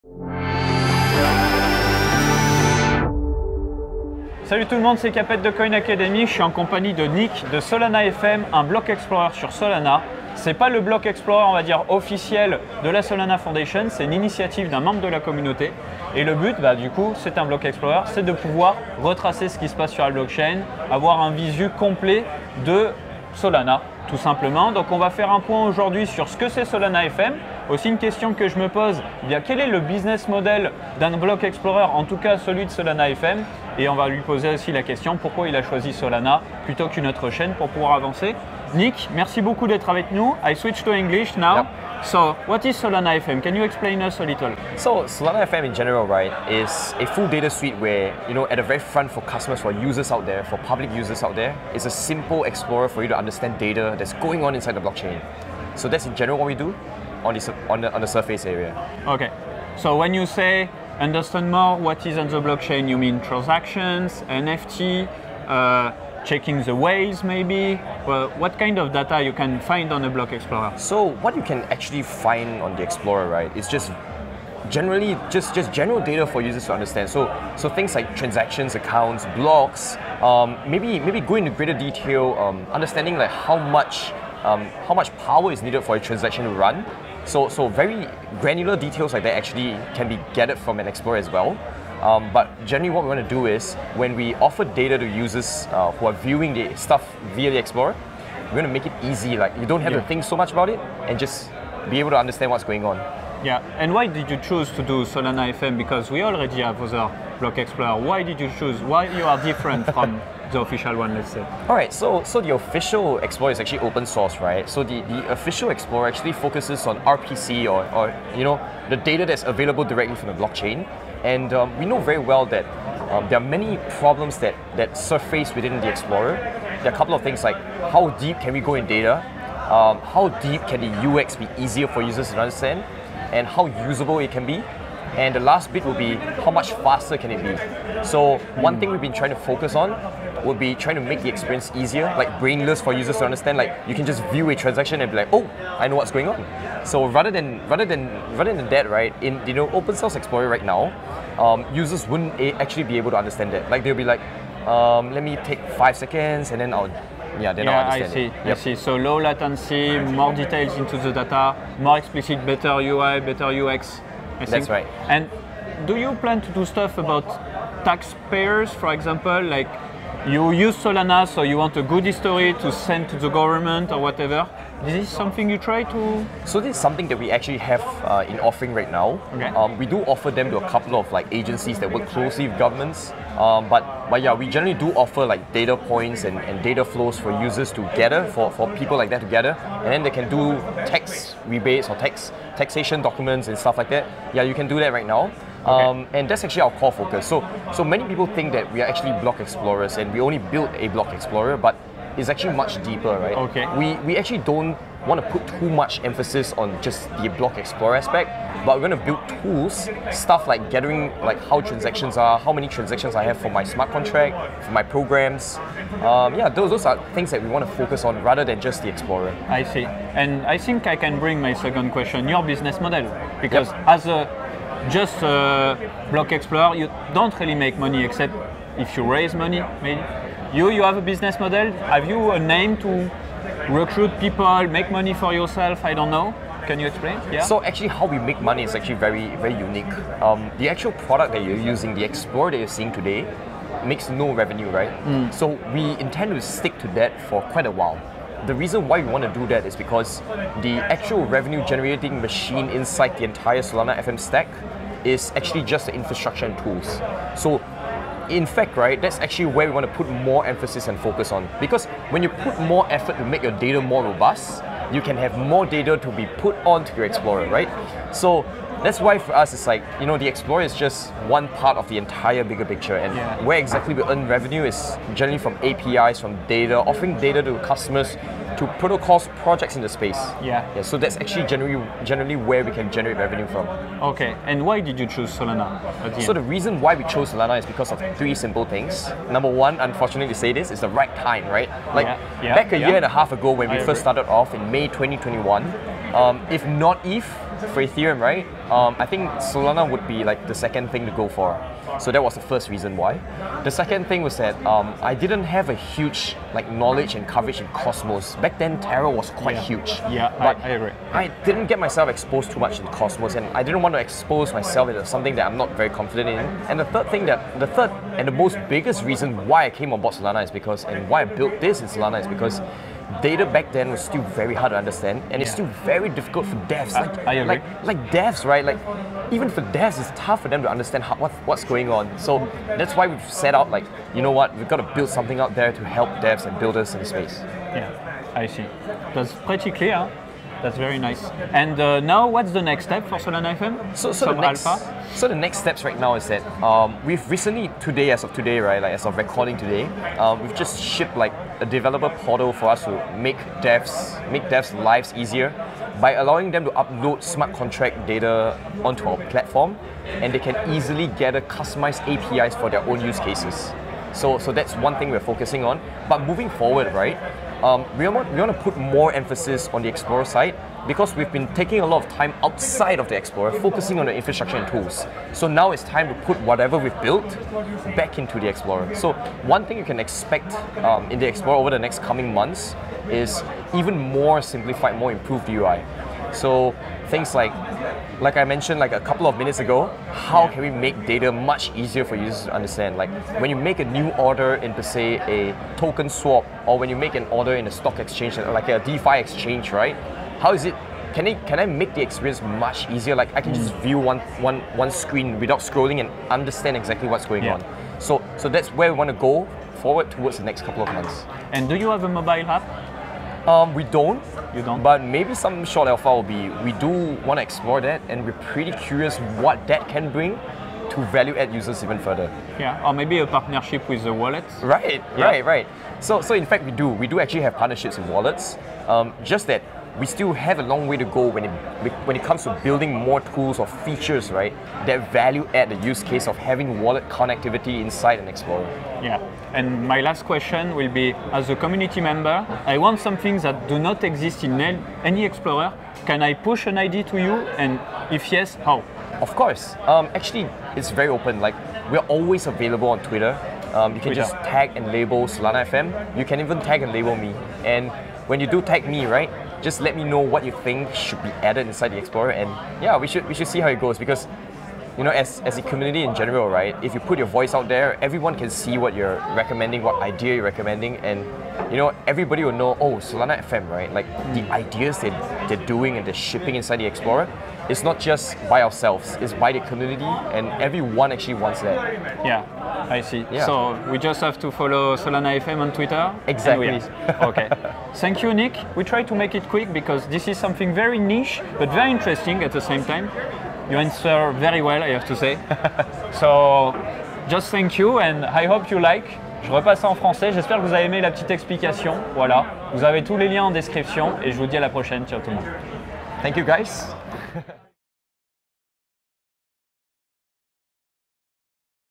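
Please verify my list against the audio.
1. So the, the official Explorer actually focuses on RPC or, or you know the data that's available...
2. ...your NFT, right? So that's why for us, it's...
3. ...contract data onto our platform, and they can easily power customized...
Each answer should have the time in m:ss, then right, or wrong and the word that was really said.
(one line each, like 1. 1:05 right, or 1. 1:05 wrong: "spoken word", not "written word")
1. 1:54 right
2. 4:26 wrong: "Explorer", not "NFT"
3. 5:57 wrong: "gather", not "power".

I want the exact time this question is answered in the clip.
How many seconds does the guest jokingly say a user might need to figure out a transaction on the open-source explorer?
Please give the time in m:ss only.
2:35.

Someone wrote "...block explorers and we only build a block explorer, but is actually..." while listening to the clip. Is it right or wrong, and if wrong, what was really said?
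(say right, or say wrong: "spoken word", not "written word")
right.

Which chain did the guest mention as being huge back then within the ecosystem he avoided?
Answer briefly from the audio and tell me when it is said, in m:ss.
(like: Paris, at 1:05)
Terra, at 5:08.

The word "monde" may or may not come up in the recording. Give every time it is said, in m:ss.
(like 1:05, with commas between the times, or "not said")
0:04, 8:25.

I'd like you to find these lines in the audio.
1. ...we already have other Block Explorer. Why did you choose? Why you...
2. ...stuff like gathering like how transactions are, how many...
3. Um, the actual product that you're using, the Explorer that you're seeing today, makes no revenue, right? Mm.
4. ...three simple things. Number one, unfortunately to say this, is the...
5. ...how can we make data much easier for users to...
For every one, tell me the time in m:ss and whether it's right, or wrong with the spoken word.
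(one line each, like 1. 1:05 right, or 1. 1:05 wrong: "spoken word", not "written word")
1. 1:46 right
2. 3:30 right
3. 4:00 right
4. 4:48 right
5. 6:30 right.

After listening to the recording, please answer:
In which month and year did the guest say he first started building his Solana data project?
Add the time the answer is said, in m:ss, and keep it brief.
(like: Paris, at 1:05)
May 2021, at 4:54.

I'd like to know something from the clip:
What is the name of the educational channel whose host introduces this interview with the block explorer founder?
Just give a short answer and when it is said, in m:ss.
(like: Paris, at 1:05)
Coin Academy, at 0:05.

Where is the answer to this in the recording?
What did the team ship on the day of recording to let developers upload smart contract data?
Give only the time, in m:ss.
5:51.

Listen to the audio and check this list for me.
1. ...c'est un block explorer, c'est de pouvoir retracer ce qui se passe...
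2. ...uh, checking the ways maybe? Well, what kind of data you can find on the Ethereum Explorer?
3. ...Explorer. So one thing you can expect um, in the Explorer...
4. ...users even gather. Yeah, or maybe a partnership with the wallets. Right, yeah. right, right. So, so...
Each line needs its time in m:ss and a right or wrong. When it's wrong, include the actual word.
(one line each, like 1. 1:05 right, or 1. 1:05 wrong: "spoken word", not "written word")
1. 0:17 right
2. 1:05 wrong: "Block", not "Ethereum"
3. 6:18 right
4. 7:01 wrong: "further", not "gather".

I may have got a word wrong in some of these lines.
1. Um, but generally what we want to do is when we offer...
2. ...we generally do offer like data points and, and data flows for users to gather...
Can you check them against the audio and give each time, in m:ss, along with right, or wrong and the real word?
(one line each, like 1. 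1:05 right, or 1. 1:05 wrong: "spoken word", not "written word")
1. 1:32 right
2. 3:04 right.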